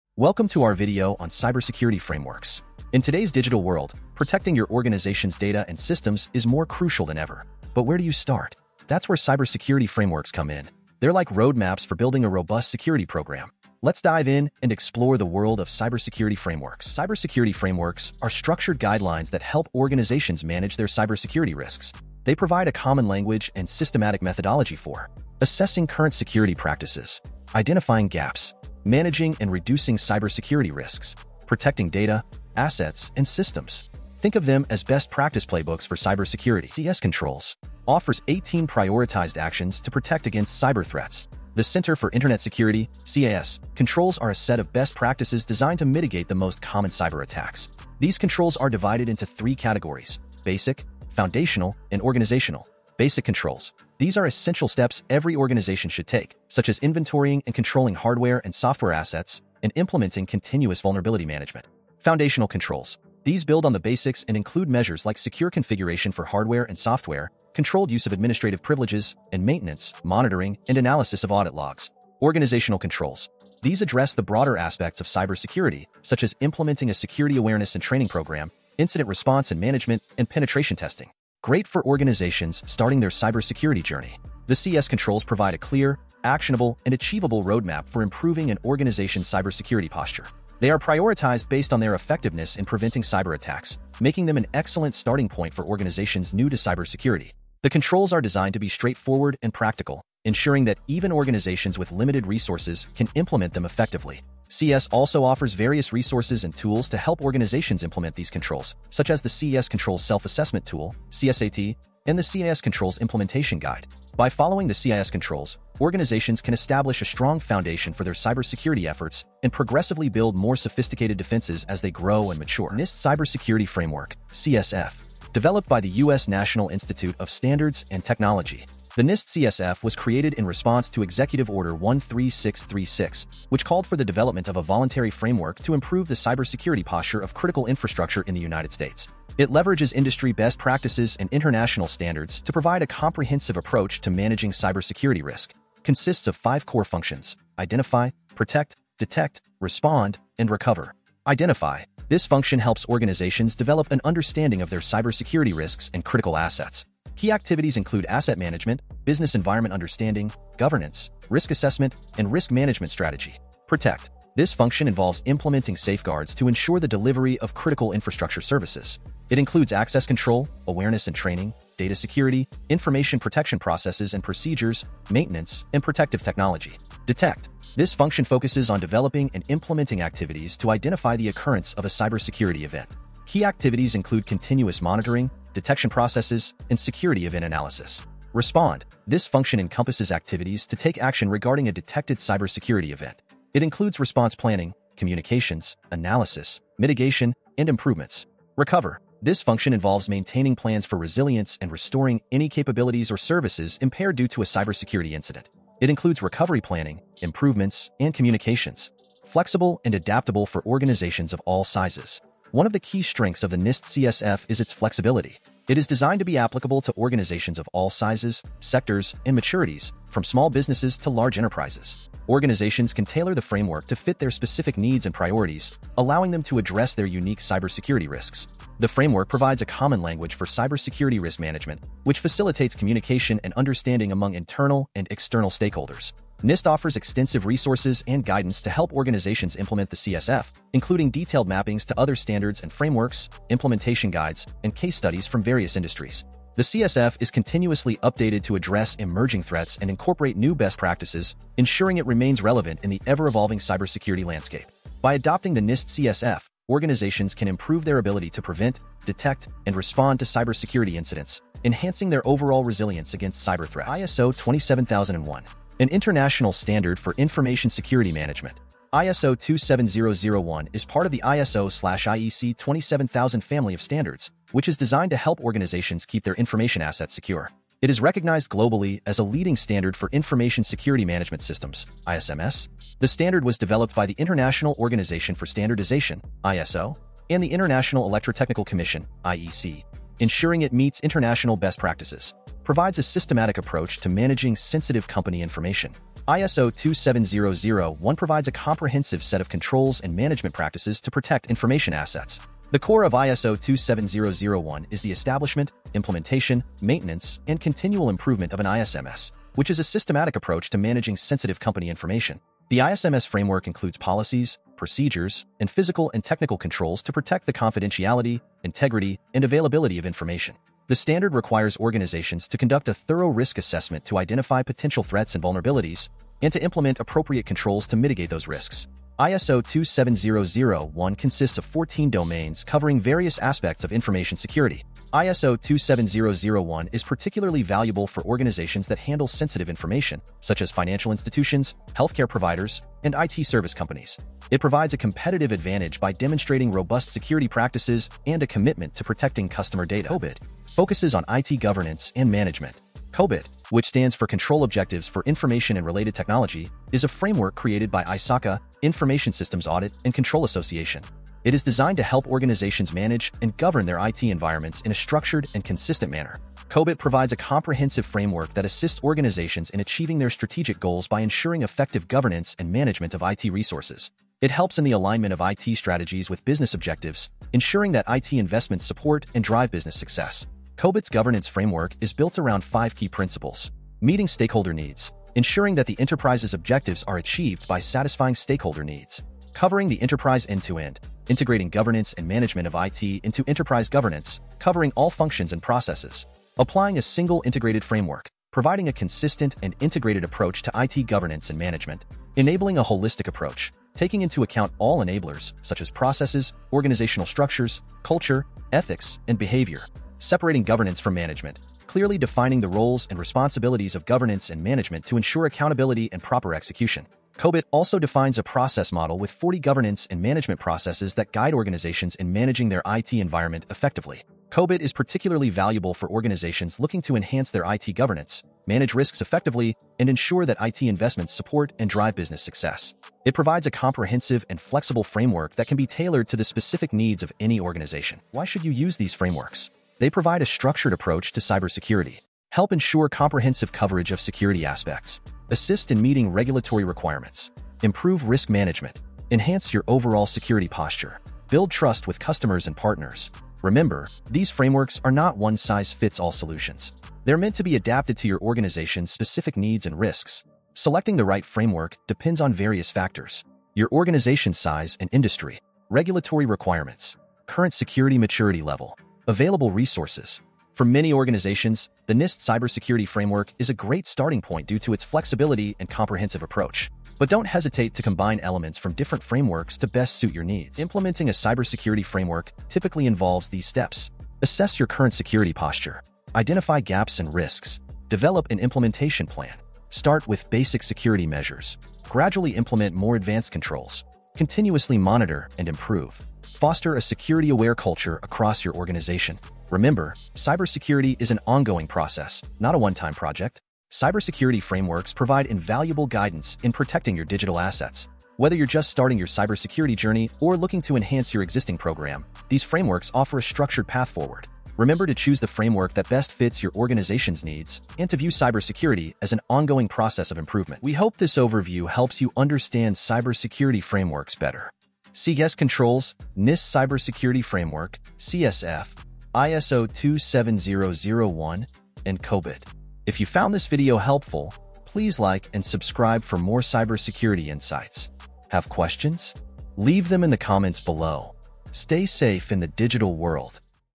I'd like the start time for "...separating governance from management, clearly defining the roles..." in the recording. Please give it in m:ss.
6:50.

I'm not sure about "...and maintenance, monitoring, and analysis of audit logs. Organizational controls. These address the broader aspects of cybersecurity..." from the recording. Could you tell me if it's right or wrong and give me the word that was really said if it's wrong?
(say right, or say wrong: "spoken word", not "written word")
right.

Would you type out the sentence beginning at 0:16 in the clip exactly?
Cybersecurity frameworks are structured guidelines that help organizations manage their cybersecurity risks.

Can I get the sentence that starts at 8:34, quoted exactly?
Remember to choose the framework that best fits your organization's needs and to view cybersecurity as an ongoing process of improvement.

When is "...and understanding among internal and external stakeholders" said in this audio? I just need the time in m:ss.
3:53.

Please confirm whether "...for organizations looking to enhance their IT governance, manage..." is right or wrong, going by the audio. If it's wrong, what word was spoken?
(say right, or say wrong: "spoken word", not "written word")
right.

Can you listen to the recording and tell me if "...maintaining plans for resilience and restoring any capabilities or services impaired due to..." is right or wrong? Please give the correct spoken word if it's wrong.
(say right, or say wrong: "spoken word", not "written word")
right.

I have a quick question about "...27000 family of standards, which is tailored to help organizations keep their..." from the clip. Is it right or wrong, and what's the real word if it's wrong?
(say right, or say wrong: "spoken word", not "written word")
wrong: "designed", not "tailored".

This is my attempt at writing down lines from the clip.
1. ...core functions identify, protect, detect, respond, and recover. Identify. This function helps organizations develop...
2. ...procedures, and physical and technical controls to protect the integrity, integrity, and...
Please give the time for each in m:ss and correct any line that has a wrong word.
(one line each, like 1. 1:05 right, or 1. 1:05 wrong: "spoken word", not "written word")
1. 2:26 right
2. 5:14 wrong: "confidentiality", not "integrity".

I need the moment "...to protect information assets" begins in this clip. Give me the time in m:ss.
5:01.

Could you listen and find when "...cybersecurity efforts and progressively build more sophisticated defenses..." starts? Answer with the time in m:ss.
1:58.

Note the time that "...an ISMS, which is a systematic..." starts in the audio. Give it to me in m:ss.
5:08.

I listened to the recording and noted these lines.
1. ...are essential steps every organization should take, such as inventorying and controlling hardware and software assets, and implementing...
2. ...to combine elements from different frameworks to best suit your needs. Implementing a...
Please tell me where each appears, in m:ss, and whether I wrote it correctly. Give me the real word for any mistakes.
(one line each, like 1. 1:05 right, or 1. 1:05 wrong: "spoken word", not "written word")
1. 0:54 right
2. 7:57 right.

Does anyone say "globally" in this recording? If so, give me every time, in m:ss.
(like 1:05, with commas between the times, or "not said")
4:38.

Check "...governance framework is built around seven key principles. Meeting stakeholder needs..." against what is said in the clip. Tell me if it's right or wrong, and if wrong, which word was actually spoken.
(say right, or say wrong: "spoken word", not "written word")
wrong: "five", not "seven".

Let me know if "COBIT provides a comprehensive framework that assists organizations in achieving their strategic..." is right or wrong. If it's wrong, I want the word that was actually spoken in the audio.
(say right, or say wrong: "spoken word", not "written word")
right.